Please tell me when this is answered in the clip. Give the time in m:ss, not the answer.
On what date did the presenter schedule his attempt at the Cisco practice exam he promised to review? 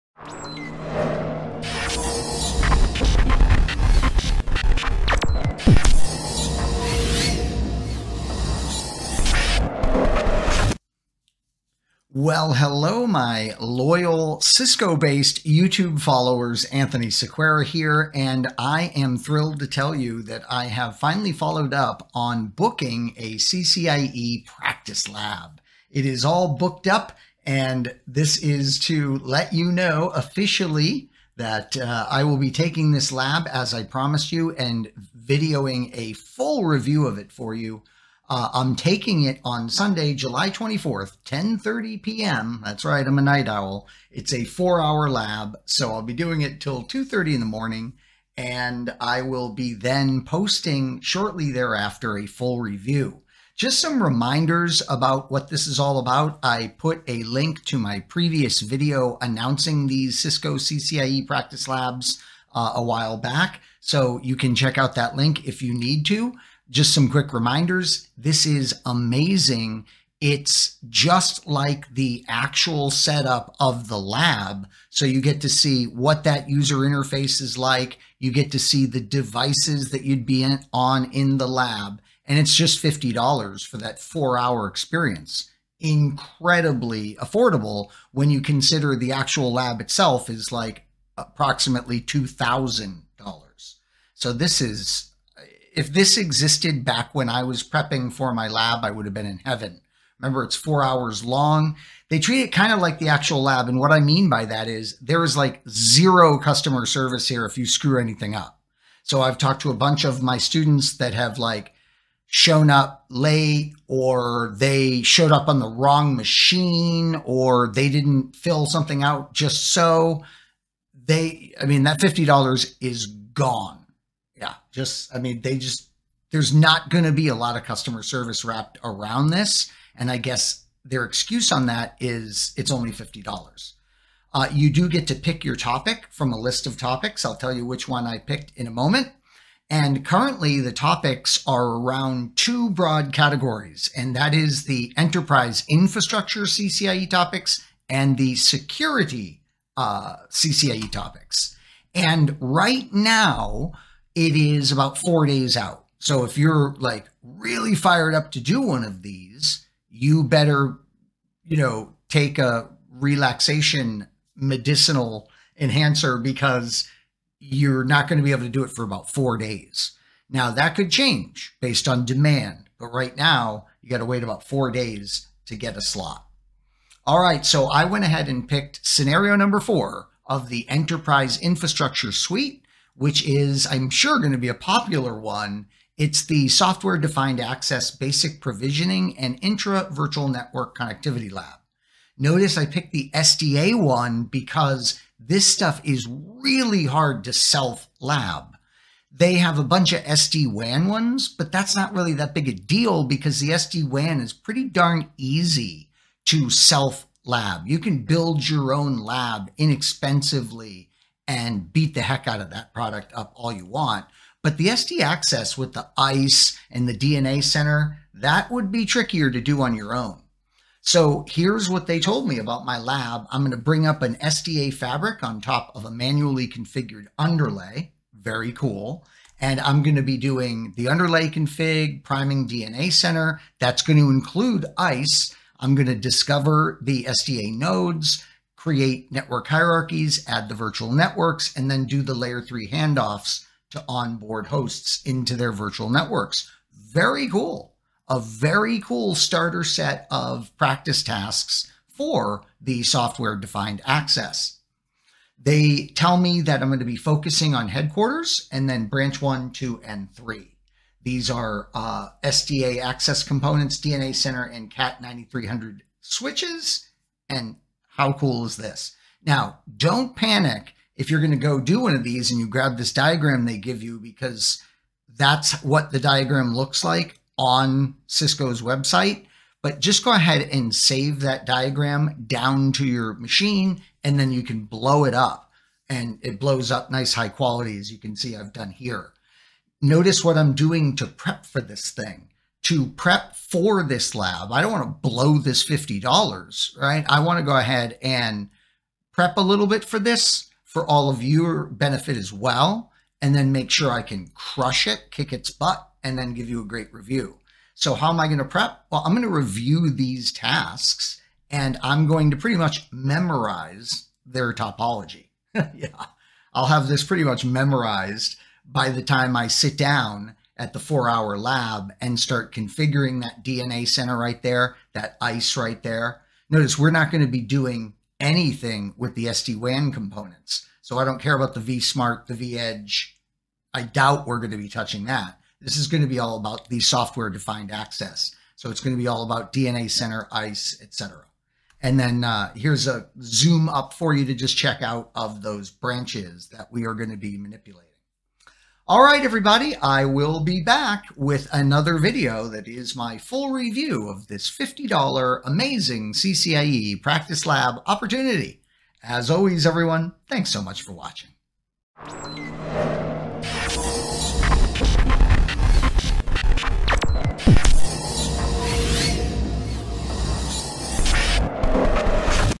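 0:40.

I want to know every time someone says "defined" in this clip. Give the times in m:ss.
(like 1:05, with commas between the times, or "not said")
3:06, 4:13, 5:37.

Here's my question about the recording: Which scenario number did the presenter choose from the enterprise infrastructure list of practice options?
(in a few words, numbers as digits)
4.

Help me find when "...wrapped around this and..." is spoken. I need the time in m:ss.
2:08.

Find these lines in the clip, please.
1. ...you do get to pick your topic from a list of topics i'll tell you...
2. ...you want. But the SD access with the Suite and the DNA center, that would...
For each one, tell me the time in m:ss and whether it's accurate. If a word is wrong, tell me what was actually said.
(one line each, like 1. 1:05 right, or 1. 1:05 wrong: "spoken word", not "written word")
1. 2:14 right
2. 3:33 wrong: "ISE", not "Suite".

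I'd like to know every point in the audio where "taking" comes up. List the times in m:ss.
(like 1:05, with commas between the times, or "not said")
0:32, 0:38.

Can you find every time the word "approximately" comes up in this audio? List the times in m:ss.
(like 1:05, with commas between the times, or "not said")
1:31.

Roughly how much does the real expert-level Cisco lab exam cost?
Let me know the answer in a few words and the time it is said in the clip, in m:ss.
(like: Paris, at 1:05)
$2,000, at 1:31.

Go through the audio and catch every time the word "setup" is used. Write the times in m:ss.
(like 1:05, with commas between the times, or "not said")
1:12.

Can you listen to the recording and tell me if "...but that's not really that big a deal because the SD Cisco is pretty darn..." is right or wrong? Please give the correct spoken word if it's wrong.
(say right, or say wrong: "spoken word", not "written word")
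wrong: "WAN", not "Cisco".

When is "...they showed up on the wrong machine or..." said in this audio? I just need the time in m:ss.
1:54.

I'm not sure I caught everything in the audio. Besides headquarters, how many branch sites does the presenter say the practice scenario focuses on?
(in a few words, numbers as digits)
3.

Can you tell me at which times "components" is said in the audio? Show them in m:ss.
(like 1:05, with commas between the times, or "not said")
4:23, 5:29.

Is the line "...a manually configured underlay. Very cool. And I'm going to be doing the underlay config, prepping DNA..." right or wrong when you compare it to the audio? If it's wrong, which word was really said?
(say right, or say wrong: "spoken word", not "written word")
wrong: "priming", not "prepping".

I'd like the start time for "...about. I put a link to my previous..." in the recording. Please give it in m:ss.
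0:55.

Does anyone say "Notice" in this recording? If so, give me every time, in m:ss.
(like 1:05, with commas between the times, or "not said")
3:12, 4:49, 5:26.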